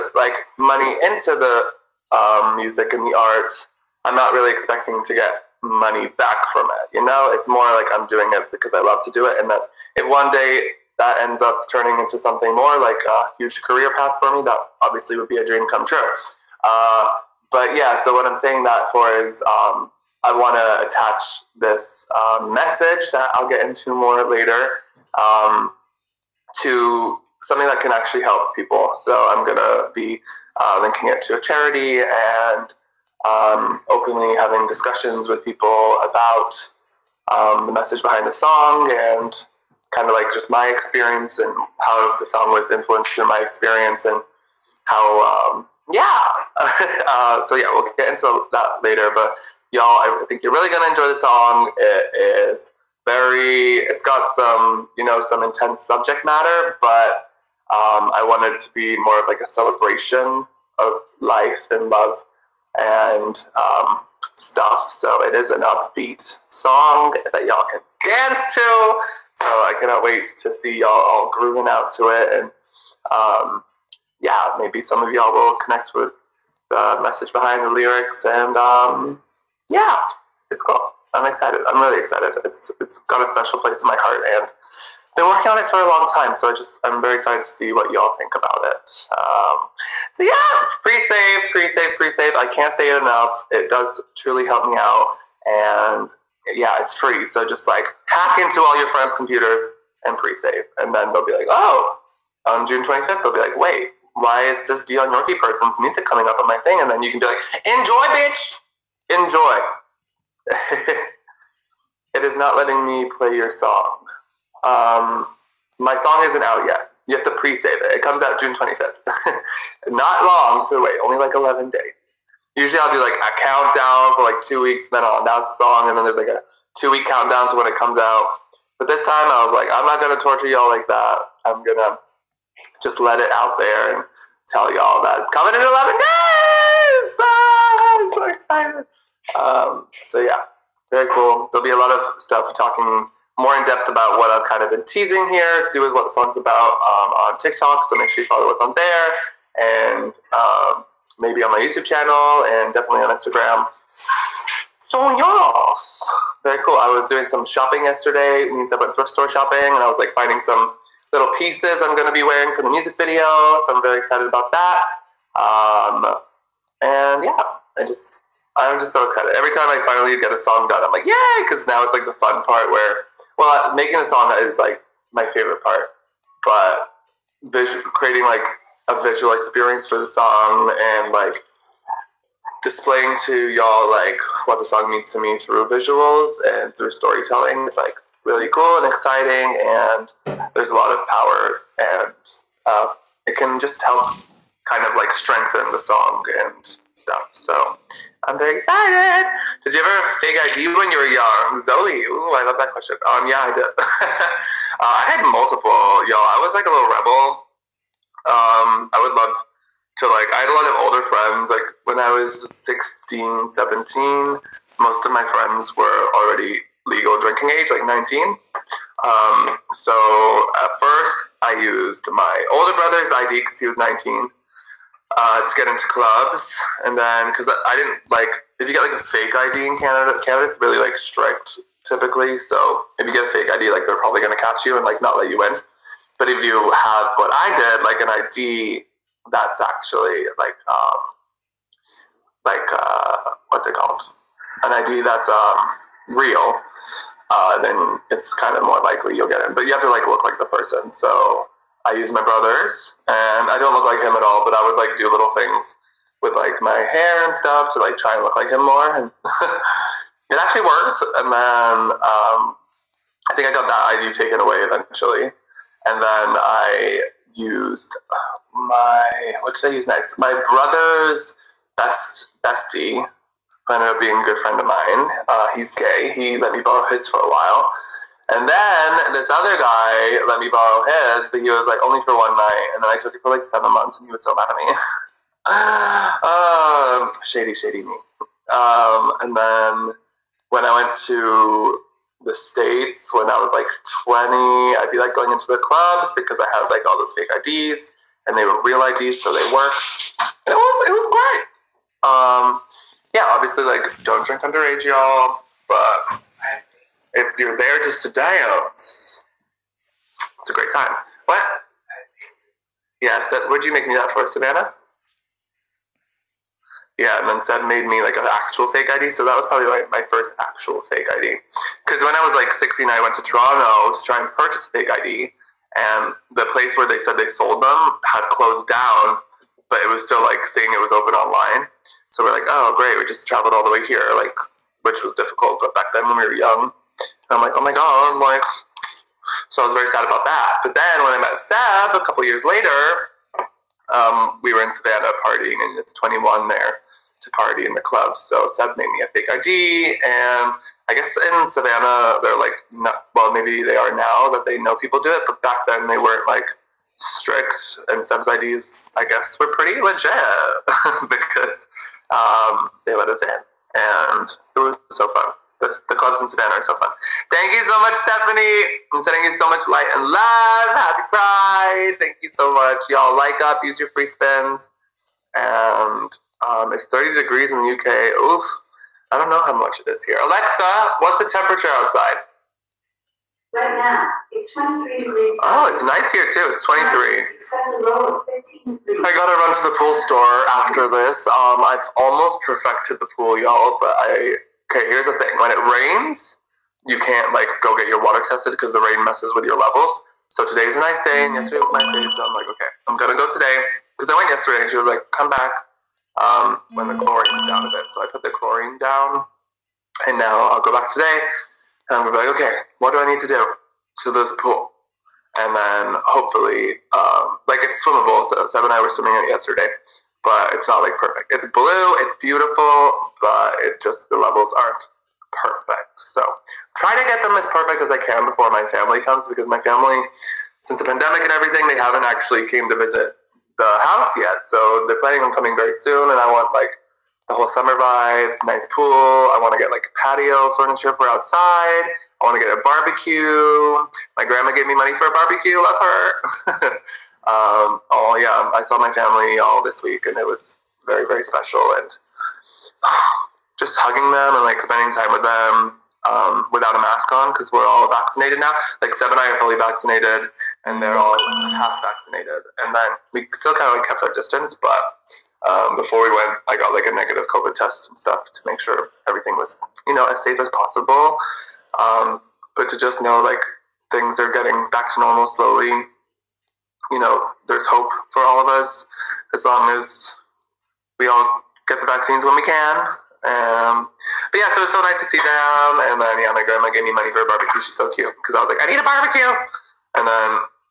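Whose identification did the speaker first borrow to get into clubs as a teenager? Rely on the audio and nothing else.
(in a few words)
Older brother's.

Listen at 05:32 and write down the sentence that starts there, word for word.
So we're like, oh great, we just traveled all the way here, like which was difficult.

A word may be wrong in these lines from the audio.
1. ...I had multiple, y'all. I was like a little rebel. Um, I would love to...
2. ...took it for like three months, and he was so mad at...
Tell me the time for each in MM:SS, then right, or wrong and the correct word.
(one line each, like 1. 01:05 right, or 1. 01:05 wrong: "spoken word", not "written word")
1. 03:24 right
2. 04:43 wrong: "seven", not "three".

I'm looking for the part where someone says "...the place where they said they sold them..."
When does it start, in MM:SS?
05:26.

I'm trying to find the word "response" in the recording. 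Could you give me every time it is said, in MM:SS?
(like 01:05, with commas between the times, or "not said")
not said.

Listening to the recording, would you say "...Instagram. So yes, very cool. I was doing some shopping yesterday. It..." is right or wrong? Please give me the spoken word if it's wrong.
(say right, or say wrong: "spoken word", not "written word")
right.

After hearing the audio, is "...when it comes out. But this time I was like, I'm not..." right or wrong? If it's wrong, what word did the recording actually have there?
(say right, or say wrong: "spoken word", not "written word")
right.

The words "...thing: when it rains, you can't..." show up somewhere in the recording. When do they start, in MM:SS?
06:35.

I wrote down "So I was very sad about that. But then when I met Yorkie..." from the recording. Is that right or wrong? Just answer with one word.
wrong.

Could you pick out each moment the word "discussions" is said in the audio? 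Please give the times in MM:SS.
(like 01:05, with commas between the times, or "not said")
00:34.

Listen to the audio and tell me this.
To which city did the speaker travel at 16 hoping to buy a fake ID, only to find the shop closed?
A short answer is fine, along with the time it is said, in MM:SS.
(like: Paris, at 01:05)
Toronto, at 05:23.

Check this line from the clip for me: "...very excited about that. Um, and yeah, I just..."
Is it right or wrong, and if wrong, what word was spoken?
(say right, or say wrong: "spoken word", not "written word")
right.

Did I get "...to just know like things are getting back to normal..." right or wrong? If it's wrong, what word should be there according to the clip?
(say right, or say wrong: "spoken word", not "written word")
right.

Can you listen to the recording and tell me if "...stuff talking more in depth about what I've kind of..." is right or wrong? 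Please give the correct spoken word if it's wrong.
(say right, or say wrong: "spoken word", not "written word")
right.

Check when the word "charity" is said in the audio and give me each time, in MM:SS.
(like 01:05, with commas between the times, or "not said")
00:31.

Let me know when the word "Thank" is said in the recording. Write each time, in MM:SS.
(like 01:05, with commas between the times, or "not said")
06:07, 06:11.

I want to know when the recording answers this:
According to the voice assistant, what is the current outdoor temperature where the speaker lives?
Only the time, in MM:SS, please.
06:24.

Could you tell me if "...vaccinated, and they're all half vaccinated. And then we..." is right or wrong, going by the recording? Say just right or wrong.
right.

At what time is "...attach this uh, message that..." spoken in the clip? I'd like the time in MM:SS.
00:20.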